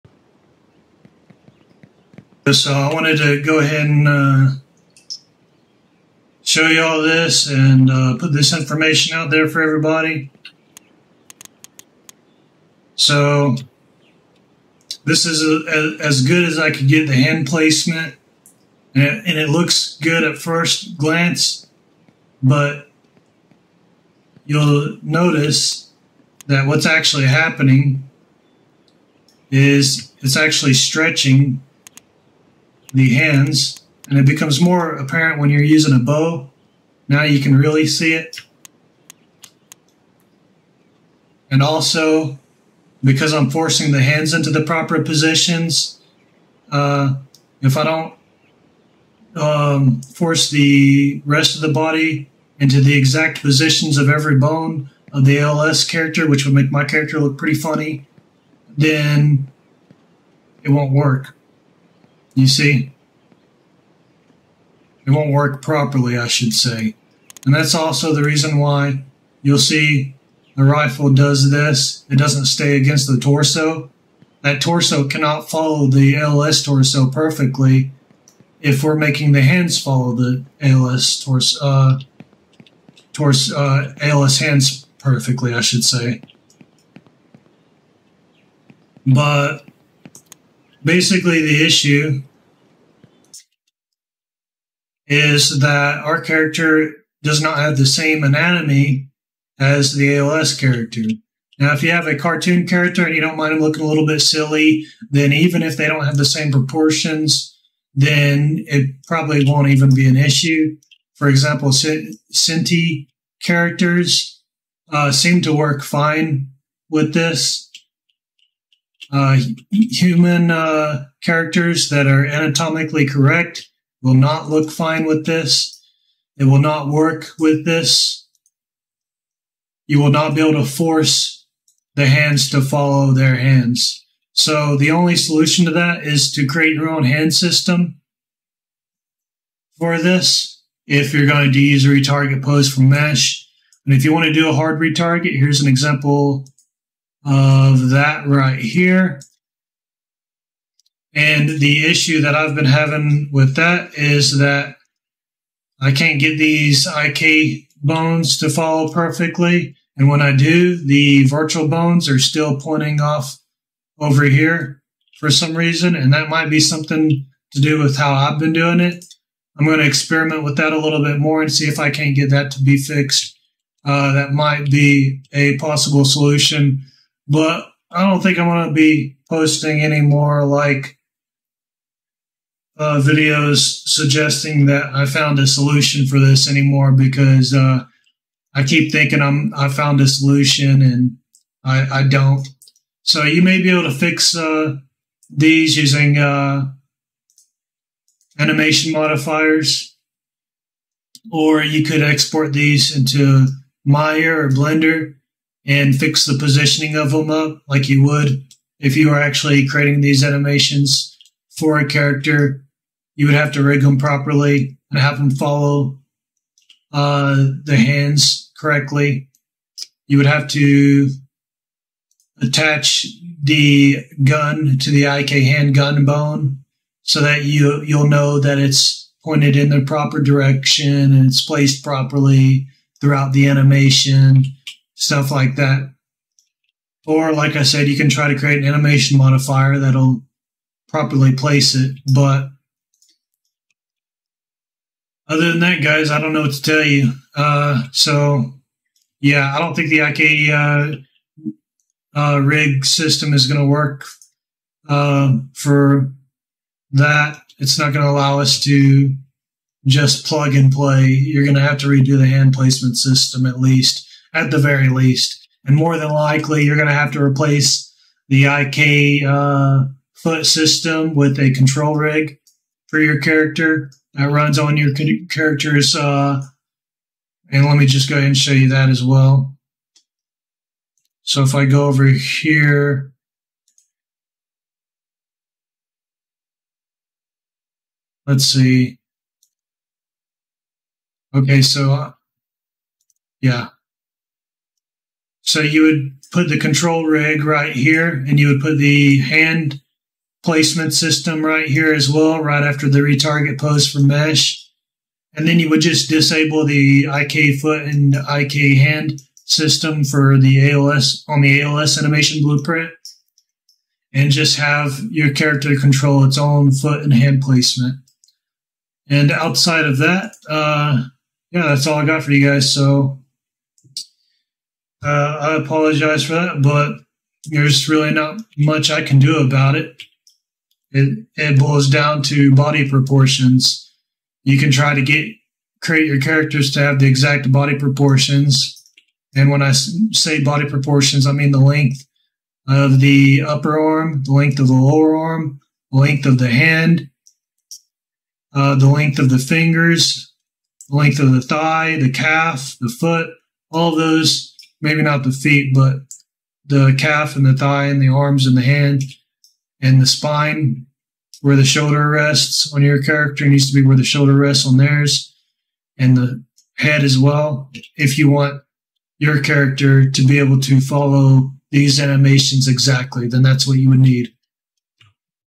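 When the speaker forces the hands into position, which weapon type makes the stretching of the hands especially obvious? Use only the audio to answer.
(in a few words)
bow.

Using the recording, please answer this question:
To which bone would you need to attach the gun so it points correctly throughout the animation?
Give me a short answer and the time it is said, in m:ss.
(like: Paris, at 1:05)
IK hand gun bone, at 3:45.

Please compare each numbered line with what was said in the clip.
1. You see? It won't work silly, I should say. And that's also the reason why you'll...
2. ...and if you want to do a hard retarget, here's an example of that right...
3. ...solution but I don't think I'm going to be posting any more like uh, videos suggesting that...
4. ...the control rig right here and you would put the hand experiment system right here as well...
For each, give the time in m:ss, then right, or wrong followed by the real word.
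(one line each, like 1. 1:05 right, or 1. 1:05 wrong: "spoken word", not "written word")
1. 1:02 wrong: "properly", not "silly"
2. 2:23 right
3. 2:56 right
4. 4:56 wrong: "placement", not "experiment".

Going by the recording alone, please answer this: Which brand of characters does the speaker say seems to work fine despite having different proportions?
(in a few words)
Synty.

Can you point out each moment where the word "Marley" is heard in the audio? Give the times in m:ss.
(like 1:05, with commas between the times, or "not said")
not said.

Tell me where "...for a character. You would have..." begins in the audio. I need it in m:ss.
3:31.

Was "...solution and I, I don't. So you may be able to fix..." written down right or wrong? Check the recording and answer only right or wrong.
right.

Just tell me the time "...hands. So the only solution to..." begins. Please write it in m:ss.
2:13.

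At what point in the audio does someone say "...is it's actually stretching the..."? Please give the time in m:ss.
0:29.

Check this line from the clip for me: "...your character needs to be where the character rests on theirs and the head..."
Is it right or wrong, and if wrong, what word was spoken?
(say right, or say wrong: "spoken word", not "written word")
wrong: "shoulder", not "character".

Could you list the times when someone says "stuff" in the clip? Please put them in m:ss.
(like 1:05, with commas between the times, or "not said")
3:55.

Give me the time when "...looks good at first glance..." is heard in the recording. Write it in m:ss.
0:19.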